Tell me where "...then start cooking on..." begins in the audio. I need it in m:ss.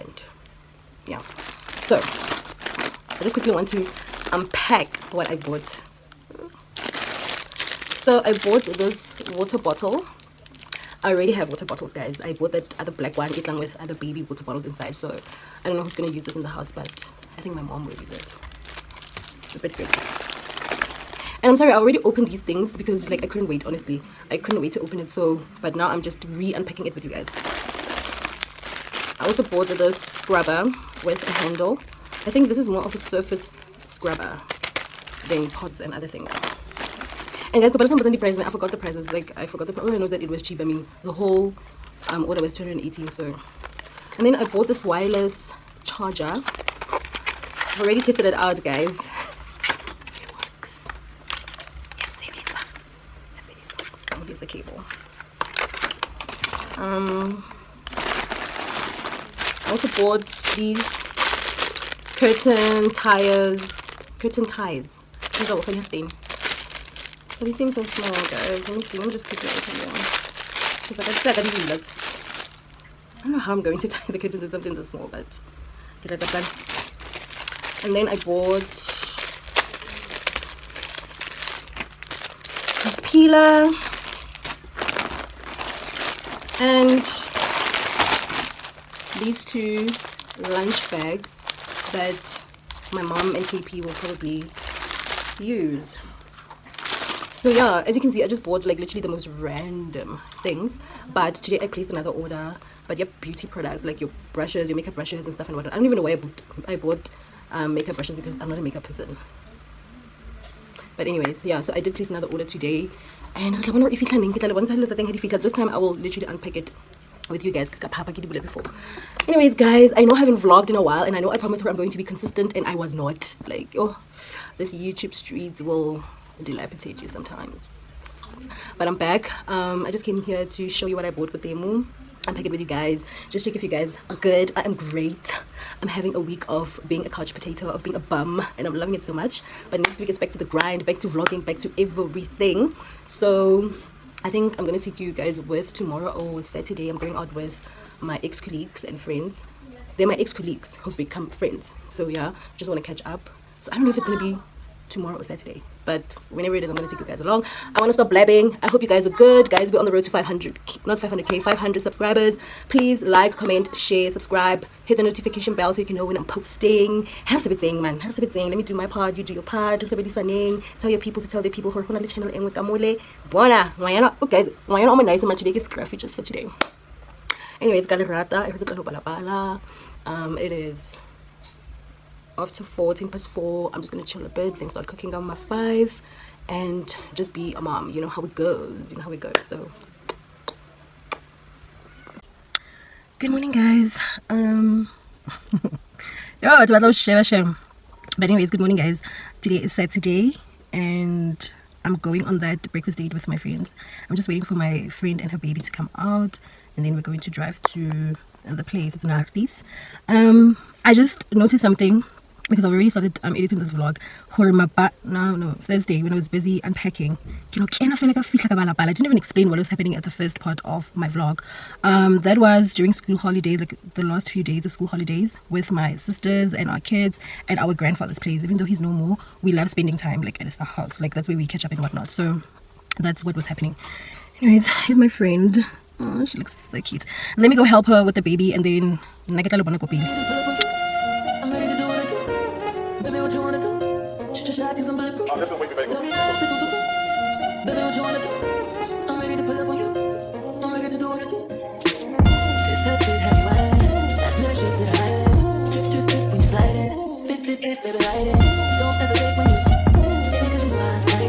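3:04.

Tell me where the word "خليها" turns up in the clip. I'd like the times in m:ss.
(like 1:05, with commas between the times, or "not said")
1:05.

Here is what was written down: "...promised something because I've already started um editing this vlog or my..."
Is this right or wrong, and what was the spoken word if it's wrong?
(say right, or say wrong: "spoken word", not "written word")
wrong: "noticed", not "promised".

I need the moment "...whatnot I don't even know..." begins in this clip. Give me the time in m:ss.
1:45.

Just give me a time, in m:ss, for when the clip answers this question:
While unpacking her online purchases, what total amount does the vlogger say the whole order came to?
0:42.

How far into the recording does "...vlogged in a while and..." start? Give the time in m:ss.
2:00.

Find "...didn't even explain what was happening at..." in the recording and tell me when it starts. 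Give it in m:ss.
3:38.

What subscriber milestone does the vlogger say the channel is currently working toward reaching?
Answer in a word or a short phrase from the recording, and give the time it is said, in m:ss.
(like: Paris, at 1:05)
500 subscribers, at 2:41.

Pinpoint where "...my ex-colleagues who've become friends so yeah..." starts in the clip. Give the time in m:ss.
2:30.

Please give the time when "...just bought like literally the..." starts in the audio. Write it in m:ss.
1:38.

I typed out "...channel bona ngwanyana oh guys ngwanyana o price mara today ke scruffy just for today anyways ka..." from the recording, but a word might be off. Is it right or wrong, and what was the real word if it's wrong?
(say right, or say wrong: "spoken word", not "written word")
wrong: "monice", not "price".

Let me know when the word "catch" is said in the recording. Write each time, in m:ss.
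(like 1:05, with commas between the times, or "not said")
2:32, 3:51.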